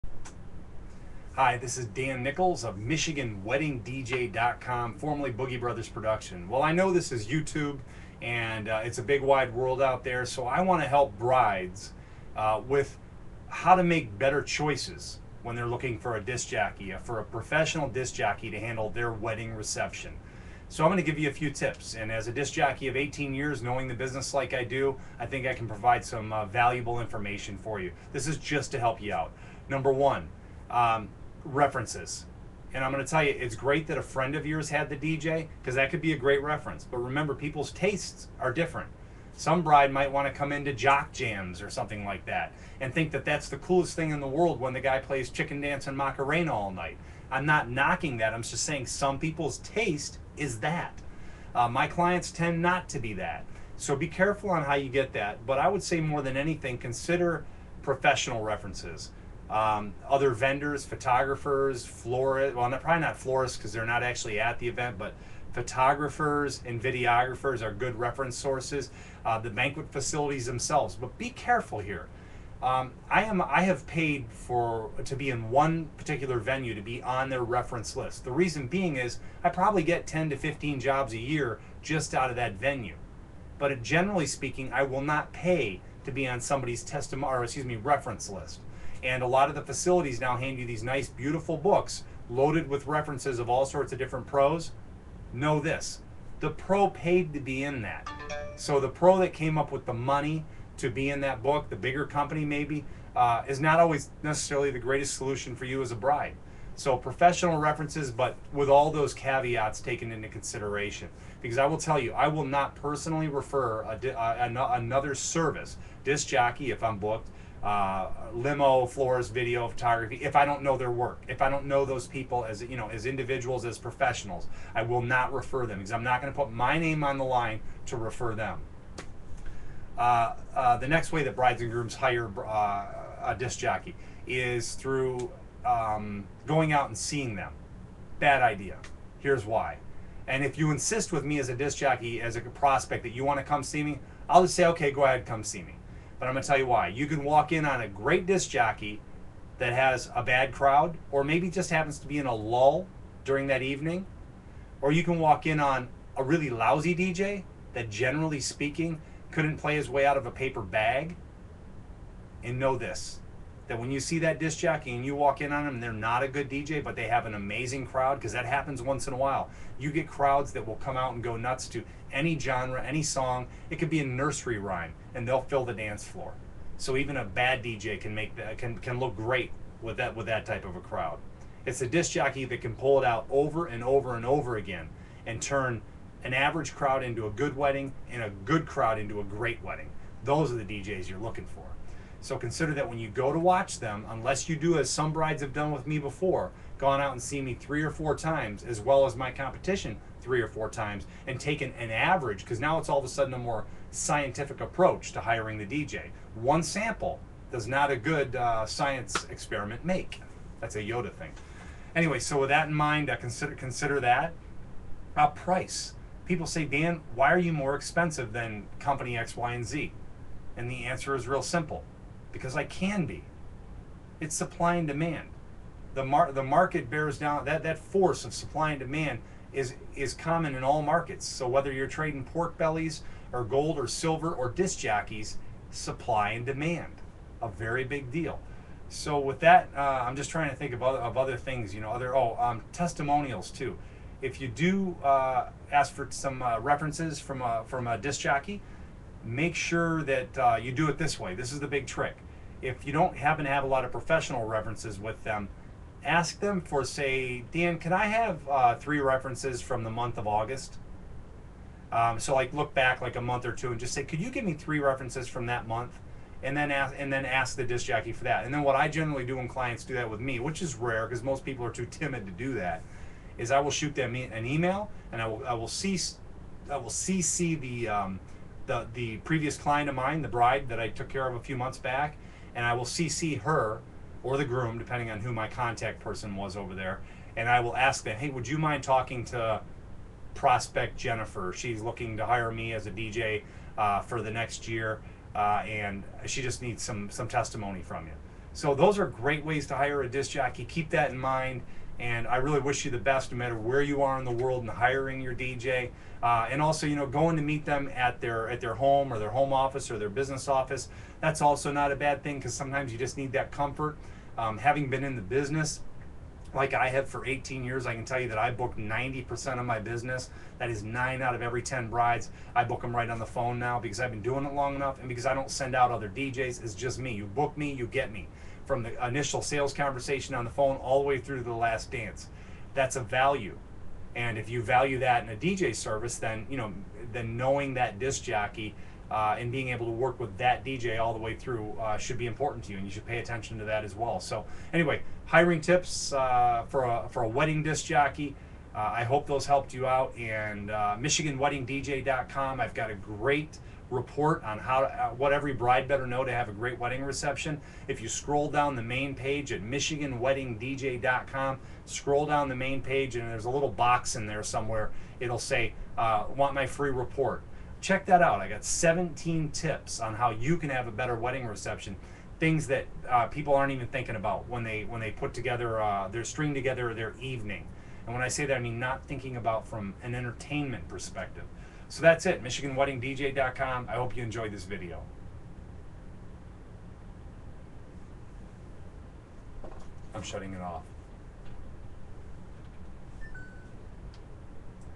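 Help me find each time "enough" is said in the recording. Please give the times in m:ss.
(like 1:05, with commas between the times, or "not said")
5:24.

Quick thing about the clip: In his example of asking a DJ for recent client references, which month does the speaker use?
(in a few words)
August.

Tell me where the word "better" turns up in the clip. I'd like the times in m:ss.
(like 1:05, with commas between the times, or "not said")
0:14, 5:55, 6:10.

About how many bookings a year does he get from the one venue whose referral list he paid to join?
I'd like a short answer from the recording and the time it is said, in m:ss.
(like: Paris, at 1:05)
10 to 15, at 1:20.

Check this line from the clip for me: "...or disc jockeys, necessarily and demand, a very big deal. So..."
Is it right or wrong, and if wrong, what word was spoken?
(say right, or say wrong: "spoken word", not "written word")
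wrong: "supply", not "necessarily".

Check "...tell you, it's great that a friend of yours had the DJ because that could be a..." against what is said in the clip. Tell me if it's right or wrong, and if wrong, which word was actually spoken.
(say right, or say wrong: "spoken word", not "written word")
right.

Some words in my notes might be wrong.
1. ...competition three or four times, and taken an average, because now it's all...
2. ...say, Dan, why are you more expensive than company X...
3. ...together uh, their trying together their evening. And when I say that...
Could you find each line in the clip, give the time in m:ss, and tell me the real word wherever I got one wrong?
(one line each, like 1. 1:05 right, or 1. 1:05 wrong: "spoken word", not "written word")
1. 3:19 right
2. 3:36 right
3. 6:15 wrong: "string", not "trying".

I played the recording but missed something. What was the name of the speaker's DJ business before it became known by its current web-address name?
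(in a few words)
Boogie Brothers Production.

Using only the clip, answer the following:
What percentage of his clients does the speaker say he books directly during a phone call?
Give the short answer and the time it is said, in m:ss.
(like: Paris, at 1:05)
90%, at 5:18.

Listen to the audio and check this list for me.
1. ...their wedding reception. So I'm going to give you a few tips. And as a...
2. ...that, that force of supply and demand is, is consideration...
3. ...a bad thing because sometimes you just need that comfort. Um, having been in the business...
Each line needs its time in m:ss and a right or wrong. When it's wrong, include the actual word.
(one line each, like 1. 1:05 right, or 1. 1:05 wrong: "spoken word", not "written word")
1. 0:18 right
2. 3:47 wrong: "common", not "consideration"
3. 5:11 right.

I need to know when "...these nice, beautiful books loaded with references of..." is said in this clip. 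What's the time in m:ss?
1:30.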